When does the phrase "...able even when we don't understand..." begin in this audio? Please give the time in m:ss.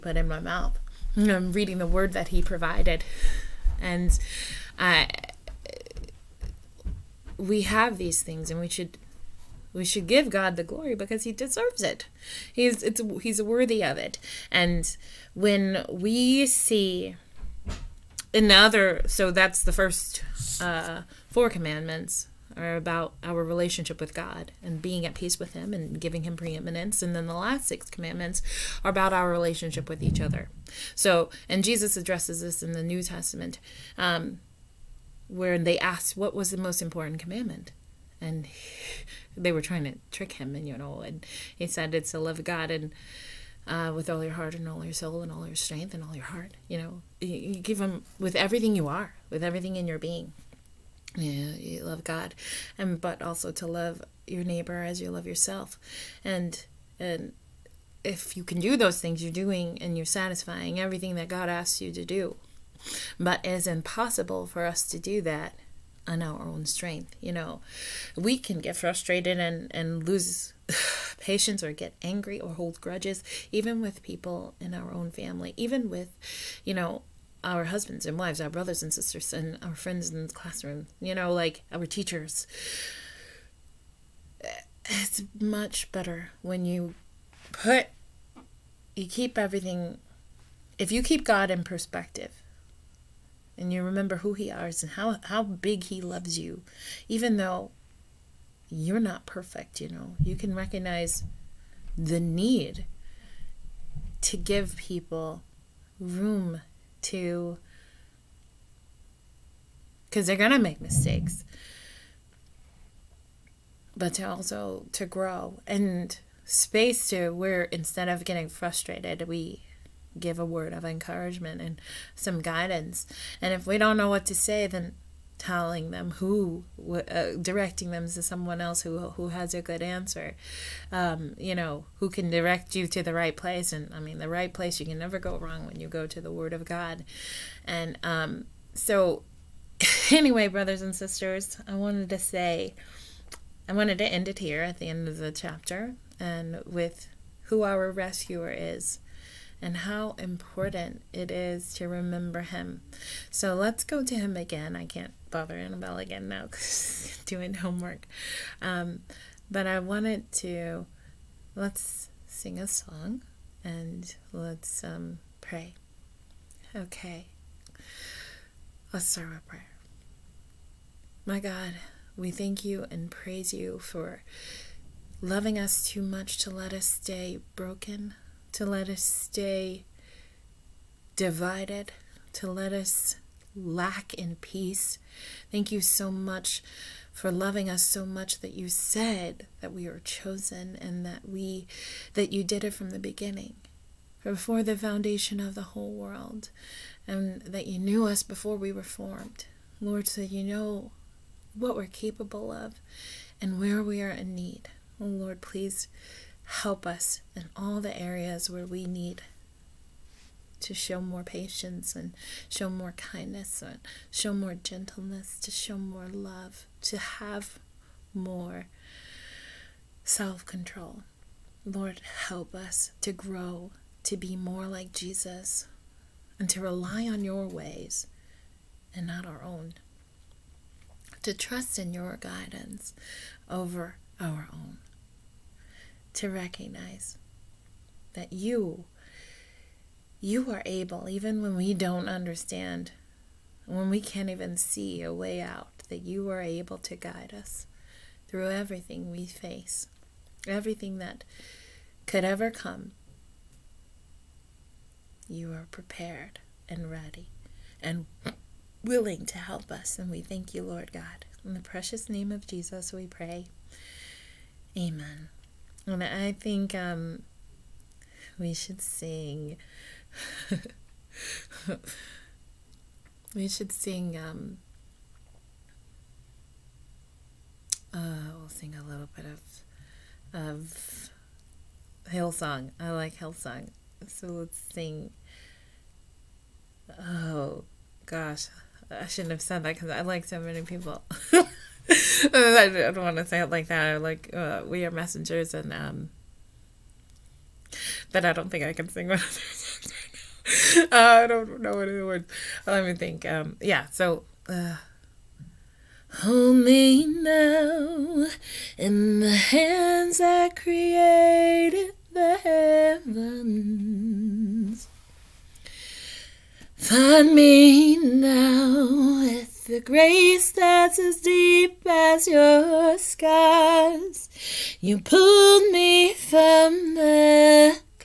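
4:00.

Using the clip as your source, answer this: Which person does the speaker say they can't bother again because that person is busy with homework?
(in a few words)
Annabelle.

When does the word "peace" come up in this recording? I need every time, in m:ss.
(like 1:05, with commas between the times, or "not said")
0:25, 3:04.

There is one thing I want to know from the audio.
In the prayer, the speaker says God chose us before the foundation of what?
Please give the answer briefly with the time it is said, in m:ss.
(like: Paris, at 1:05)
the whole world, at 3:15.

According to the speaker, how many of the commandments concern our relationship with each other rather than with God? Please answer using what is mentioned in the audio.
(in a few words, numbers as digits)
6.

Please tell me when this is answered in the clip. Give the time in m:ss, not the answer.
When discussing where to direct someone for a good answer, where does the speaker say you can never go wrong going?
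2:16.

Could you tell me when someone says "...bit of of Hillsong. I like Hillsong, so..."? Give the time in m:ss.
4:39.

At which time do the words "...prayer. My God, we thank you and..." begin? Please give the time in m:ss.
2:49.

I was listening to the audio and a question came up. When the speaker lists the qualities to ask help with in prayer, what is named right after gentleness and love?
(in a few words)
self control.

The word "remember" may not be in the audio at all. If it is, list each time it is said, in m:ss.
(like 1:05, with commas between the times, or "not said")
1:33, 2:31.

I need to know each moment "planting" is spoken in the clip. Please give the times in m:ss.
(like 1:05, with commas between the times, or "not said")
not said.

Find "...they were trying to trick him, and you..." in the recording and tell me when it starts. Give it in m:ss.
0:39.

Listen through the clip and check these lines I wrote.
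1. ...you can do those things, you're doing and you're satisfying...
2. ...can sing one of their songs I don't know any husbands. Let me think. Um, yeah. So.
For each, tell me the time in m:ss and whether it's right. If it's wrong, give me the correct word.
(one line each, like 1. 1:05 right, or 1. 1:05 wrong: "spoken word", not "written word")
1. 0:58 right
2. 4:58 wrong: "words", not "husbands".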